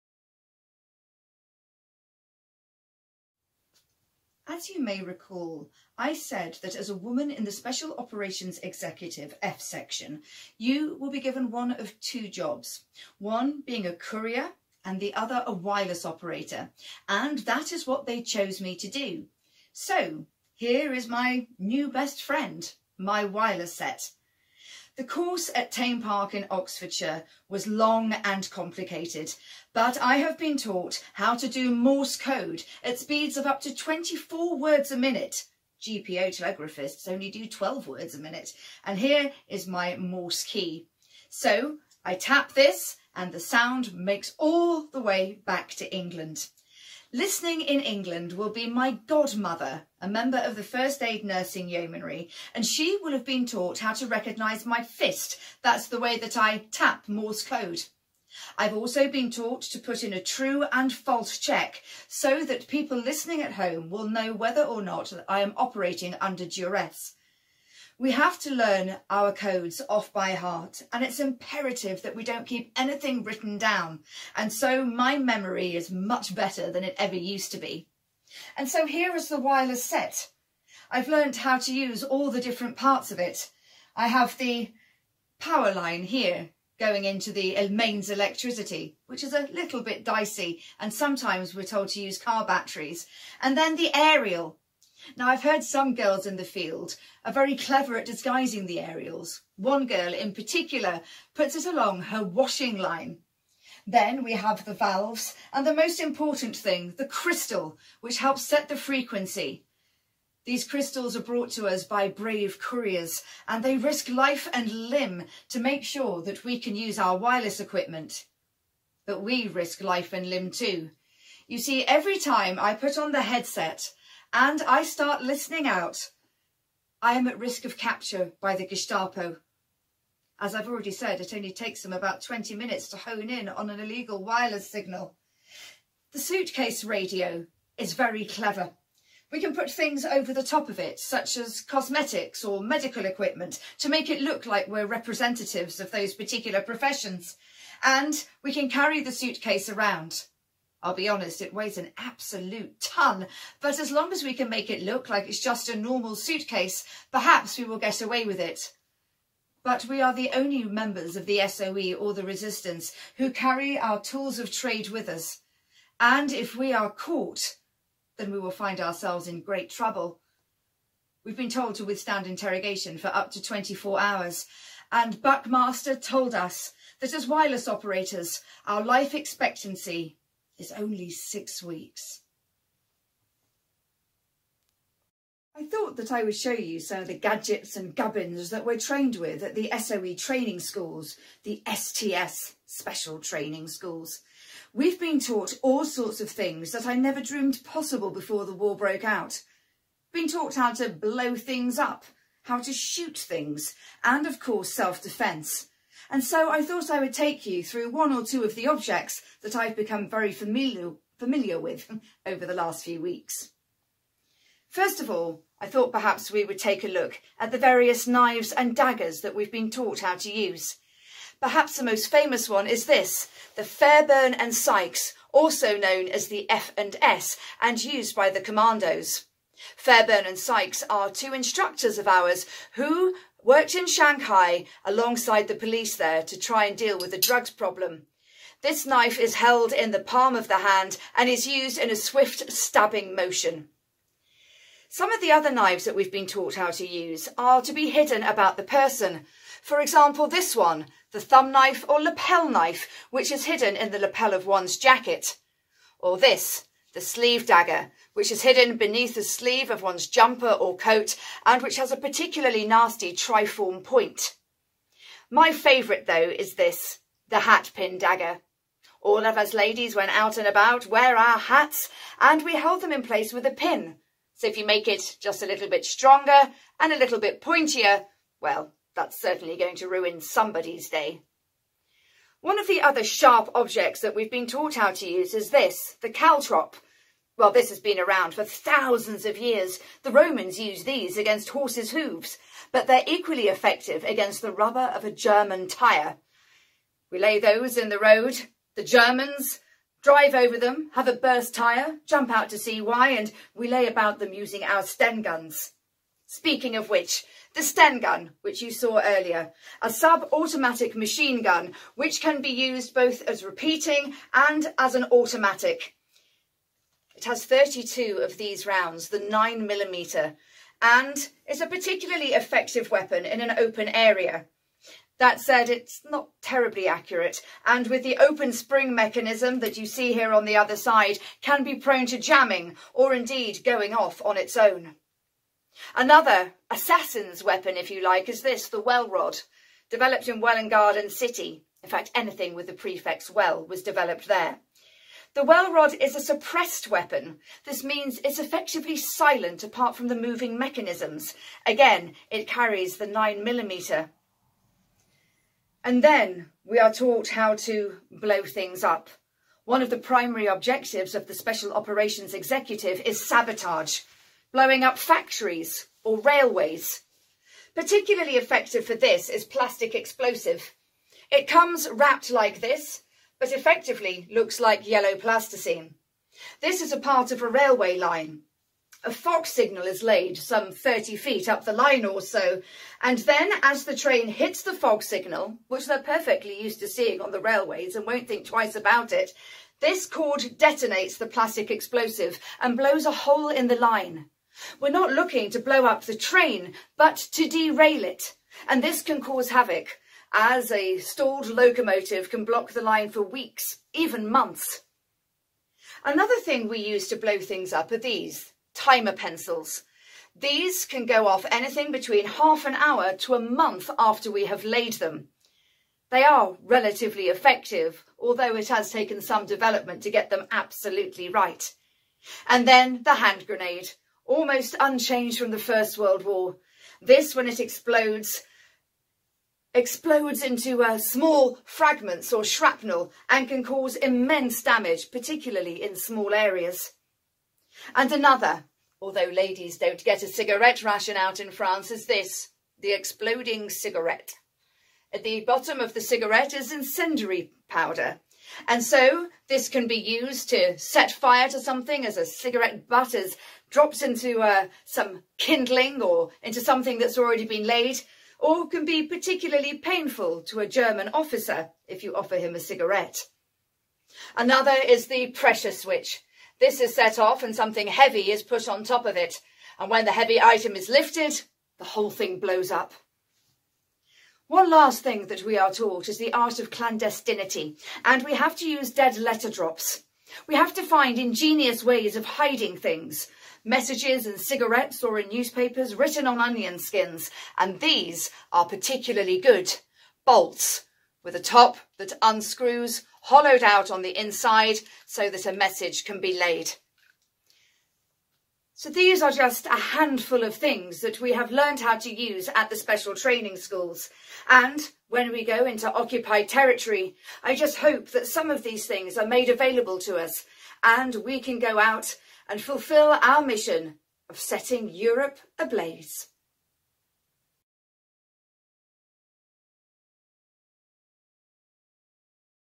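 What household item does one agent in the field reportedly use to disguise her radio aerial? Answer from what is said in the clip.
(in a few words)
Her washing line.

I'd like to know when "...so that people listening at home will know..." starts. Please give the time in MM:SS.
01:02.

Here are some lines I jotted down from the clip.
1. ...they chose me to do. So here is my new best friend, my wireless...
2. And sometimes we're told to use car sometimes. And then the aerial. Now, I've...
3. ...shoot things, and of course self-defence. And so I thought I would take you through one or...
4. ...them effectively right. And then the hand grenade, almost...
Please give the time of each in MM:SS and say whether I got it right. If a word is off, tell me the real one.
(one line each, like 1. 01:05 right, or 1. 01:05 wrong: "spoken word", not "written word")
1. 00:18 right
2. 01:30 wrong: "batteries", not "sometimes"
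3. 03:22 right
4. 07:00 wrong: "absolutely", not "effectively".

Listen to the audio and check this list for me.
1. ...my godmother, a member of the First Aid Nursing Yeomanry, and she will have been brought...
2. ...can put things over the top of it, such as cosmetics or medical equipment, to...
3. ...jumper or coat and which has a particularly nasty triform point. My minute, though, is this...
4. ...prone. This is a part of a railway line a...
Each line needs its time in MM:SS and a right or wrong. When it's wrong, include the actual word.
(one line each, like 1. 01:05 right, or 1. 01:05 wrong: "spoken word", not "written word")
1. 00:48 wrong: "taught", not "brought"
2. 02:19 right
3. 04:20 wrong: "favourite", not "minute"
4. 06:15 wrong: "plasticine", not "prone".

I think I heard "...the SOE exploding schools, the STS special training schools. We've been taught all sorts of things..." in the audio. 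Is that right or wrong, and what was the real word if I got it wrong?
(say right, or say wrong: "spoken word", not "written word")
wrong: "training", not "exploding".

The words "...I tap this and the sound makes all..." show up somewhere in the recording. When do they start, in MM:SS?
00:42.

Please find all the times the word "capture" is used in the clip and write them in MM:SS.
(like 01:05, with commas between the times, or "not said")
02:07.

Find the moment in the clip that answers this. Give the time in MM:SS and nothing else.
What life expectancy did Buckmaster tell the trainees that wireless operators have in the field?
03:01.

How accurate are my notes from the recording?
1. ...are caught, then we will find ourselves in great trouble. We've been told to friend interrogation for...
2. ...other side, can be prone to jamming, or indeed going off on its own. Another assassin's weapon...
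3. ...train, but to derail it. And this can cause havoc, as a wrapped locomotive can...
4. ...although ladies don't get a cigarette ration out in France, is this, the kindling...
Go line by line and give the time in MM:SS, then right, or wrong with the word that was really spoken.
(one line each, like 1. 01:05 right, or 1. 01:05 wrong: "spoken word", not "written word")
1. 02:46 wrong: "withstand", not "friend"
2. 05:30 right
3. 06:36 wrong: "stalled", not "wrapped"
4. 07:19 wrong: "exploding", not "kindling".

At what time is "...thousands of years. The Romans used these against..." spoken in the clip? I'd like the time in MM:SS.
04:48.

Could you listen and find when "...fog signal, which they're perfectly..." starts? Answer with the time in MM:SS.
06:24.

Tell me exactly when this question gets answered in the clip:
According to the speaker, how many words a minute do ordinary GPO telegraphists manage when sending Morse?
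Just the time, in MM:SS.
00:37.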